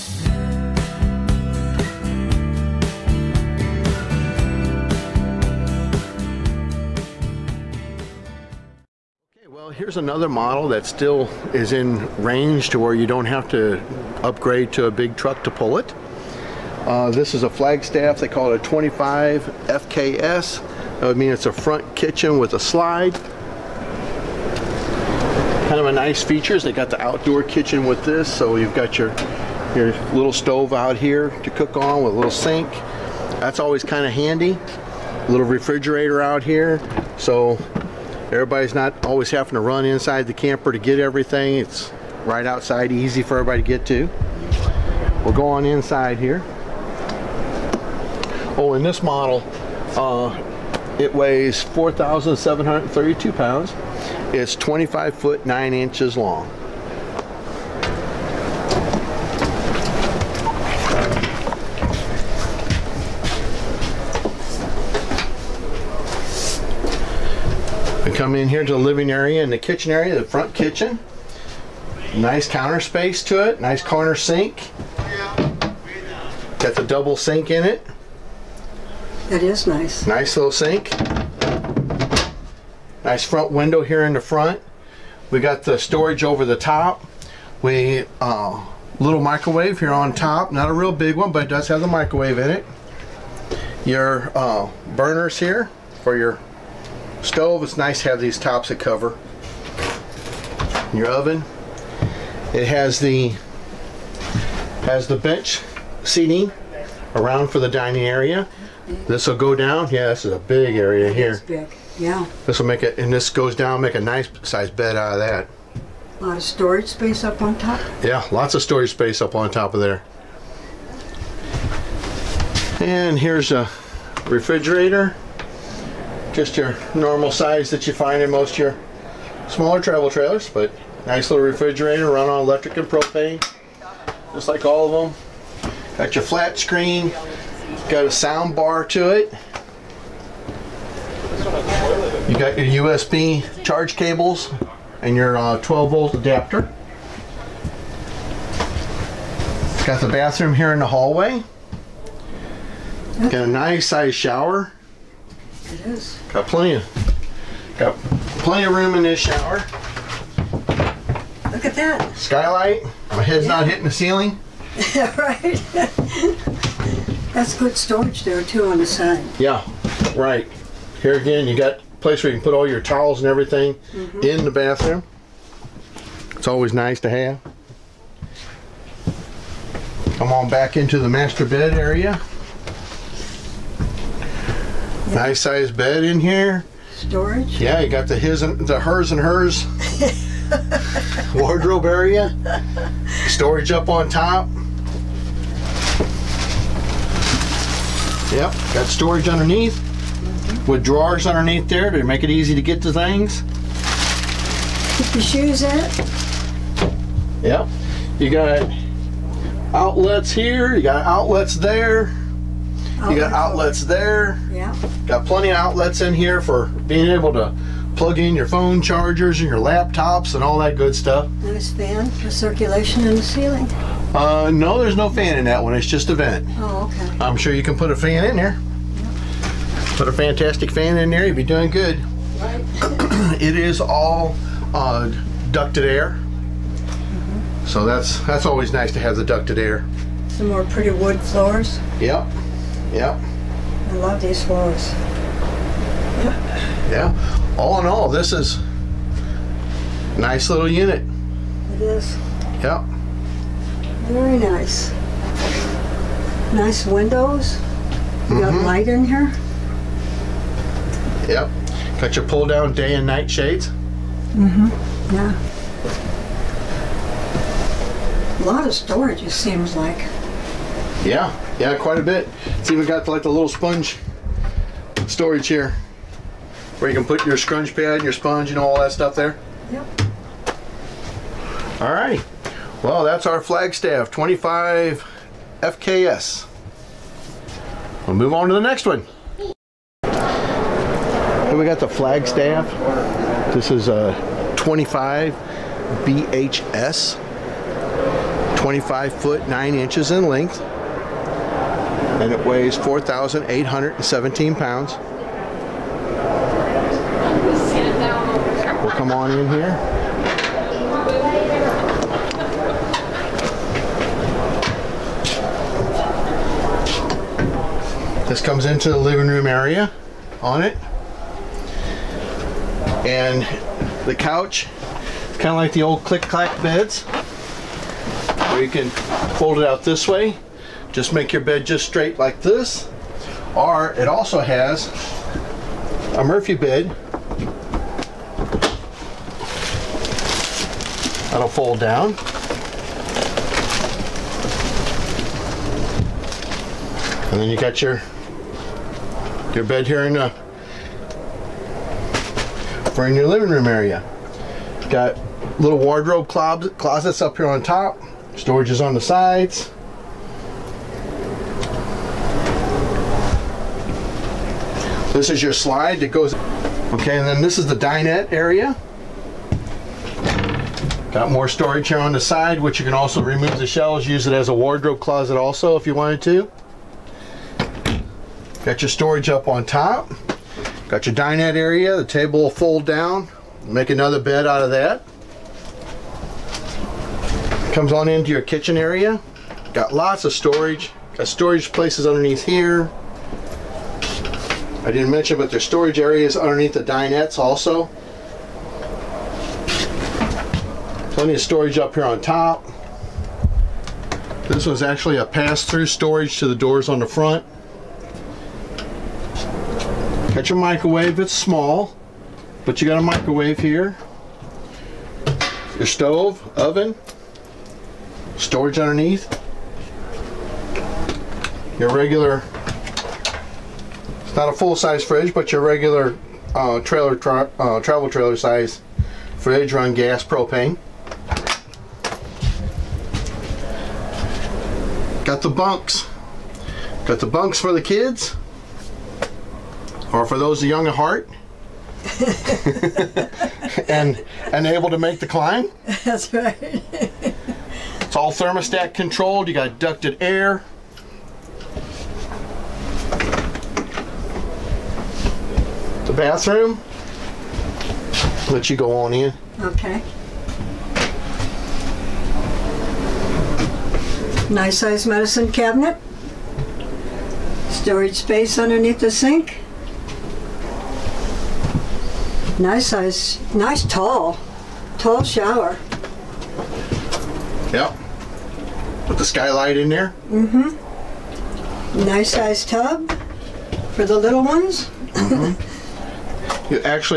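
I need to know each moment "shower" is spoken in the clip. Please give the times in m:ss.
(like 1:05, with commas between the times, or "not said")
2:34, 2:39, 7:55.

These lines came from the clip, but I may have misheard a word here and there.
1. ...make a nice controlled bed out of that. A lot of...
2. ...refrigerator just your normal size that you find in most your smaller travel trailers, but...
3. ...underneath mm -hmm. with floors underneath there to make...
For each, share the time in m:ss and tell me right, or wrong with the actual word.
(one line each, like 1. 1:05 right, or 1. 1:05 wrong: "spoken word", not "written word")
1. 1:53 wrong: "sized", not "controlled"
2. 2:04 right
3. 3:19 wrong: "drawers", not "floors".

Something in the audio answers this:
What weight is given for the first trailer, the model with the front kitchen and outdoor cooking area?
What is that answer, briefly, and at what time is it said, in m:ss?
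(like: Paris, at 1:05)
4,732 pounds, at 0:51.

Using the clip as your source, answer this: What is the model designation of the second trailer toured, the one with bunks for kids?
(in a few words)
25 BHS.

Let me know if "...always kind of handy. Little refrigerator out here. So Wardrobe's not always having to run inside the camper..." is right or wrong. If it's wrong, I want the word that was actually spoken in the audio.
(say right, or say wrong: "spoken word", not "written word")
wrong: "Everybody", not "Wardrobe".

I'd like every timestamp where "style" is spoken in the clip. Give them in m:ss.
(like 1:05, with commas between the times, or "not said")
not said.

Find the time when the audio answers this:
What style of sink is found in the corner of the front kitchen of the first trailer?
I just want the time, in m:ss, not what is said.
1:16.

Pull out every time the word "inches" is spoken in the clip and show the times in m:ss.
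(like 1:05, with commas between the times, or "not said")
0:55, 4:59.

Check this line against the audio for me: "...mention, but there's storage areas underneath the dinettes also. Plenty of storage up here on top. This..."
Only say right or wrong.
right.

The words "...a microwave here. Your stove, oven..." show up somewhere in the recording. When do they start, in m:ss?
6:52.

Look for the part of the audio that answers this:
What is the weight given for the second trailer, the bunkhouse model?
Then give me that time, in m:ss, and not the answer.
5:02.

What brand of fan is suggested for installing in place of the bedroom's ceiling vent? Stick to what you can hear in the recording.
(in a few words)
fantastic fan.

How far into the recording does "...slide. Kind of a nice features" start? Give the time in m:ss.
0:22.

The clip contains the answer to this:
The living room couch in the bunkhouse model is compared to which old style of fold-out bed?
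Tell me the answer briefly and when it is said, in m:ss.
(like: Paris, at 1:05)
click-clack beds, at 5:26.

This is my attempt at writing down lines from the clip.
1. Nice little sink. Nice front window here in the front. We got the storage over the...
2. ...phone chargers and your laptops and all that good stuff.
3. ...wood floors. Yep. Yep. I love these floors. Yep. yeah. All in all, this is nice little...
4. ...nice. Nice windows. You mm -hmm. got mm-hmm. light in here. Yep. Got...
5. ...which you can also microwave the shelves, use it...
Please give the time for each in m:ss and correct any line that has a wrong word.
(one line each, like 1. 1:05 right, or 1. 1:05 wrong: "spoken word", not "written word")
1. 1:20 right
2. 3:38 right
3. 4:00 right
4. 4:14 right
5. 6:12 wrong: "remove", not "microwave".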